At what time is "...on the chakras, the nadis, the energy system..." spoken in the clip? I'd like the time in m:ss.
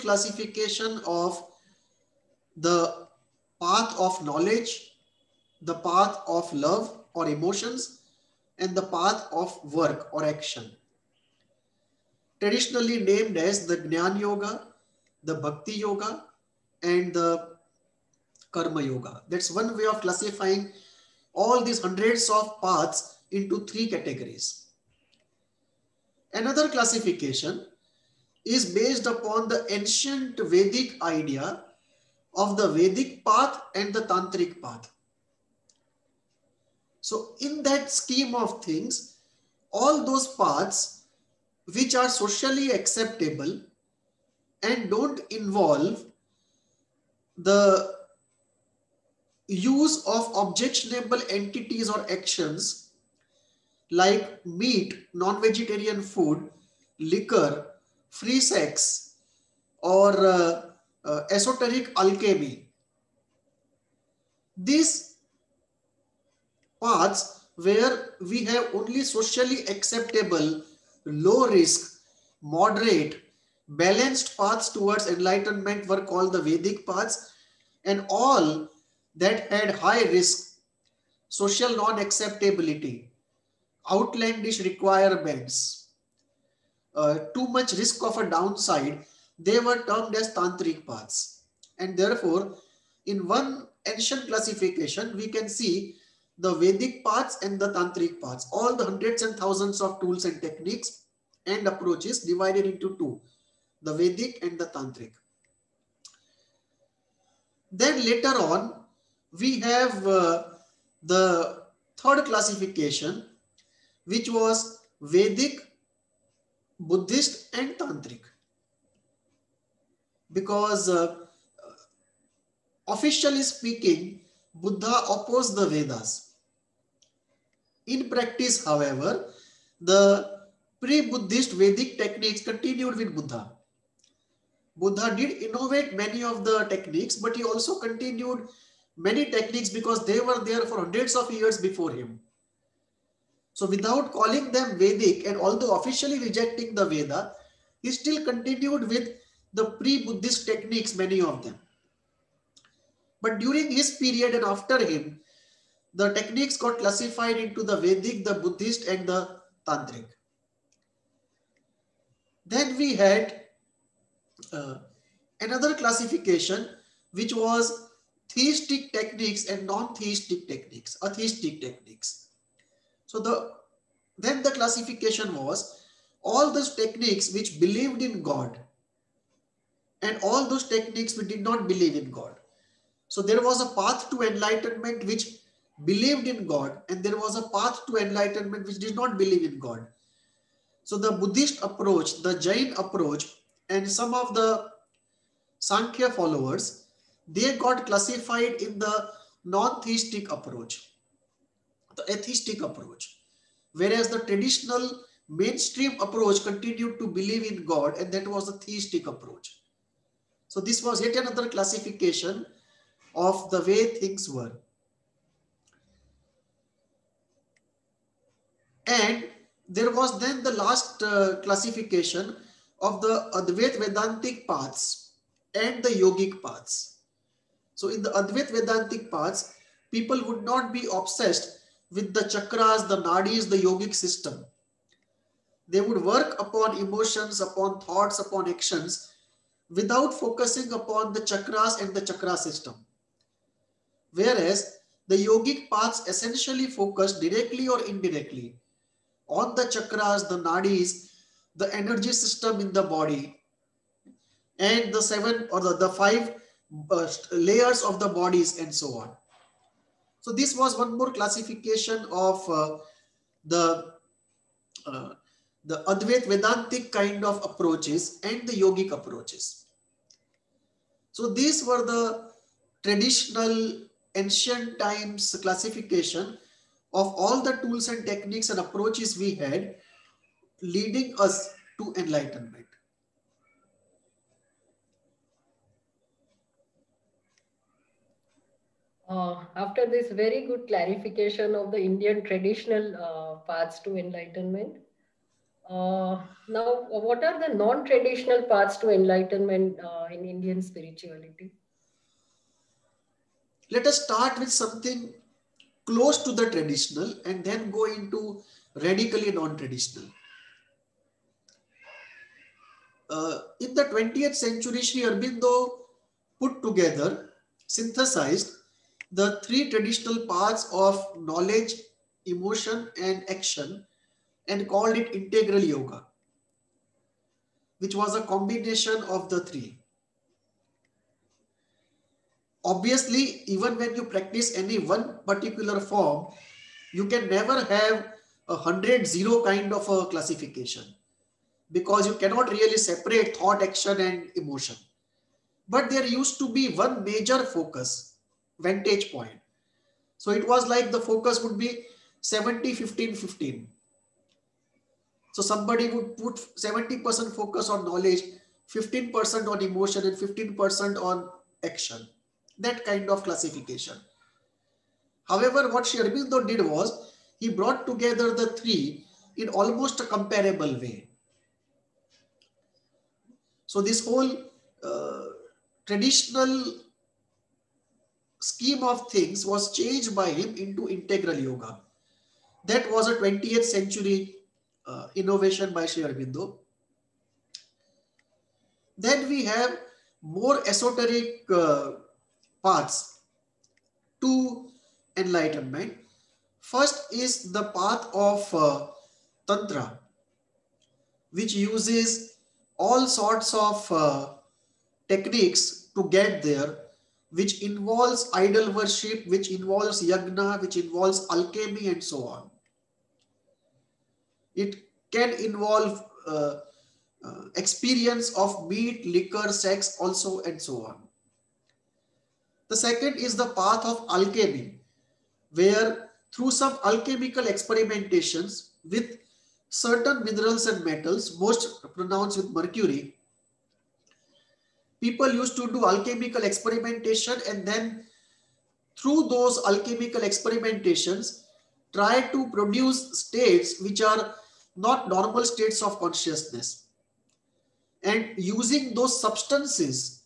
4:09.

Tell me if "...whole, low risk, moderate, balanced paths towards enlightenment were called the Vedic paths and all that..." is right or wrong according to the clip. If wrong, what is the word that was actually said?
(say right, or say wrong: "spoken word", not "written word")
wrong: "acceptable", not "whole".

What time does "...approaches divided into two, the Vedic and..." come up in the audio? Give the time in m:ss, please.
1:41.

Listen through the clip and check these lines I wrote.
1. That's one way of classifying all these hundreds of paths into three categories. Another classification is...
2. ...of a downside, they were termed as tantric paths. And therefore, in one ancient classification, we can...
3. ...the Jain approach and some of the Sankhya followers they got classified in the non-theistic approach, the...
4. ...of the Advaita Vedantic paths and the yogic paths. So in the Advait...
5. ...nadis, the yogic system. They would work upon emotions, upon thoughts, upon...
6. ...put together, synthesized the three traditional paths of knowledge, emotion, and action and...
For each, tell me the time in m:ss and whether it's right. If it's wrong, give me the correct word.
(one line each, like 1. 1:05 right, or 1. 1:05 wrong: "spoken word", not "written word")
1. 0:19 right
2. 1:28 right
3. 3:12 right
4. 3:42 right
5. 3:53 right
6. 5:16 right.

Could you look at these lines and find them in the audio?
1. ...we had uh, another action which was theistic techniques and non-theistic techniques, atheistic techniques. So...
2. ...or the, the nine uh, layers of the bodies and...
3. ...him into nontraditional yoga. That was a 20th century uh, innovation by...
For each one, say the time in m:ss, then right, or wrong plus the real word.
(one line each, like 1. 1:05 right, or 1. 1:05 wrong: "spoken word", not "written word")
1. 2:42 wrong: "classification", not "action"
2. 4:15 wrong: "five", not "nine"
3. 6:20 wrong: "integral", not "nontraditional".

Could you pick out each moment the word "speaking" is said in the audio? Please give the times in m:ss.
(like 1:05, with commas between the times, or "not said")
2:03.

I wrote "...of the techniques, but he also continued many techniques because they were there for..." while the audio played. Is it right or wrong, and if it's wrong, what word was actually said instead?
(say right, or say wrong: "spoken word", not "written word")
right.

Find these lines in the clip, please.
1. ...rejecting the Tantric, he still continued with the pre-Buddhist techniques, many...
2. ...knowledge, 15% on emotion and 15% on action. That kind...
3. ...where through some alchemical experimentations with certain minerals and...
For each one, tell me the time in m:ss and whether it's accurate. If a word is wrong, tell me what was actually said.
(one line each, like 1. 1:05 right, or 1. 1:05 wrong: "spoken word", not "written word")
1. 2:26 wrong: "Veda", not "Tantric"
2. 5:57 right
3. 7:05 right.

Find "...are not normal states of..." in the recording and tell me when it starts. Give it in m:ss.
7:24.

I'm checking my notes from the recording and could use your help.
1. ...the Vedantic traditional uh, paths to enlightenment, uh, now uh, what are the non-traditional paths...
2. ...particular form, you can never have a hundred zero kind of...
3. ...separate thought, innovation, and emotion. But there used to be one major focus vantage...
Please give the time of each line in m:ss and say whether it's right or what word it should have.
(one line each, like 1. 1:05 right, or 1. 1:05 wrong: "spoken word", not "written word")
1. 4:51 wrong: "Indian", not "Vedantic"
2. 5:35 right
3. 5:42 wrong: "action", not "innovation".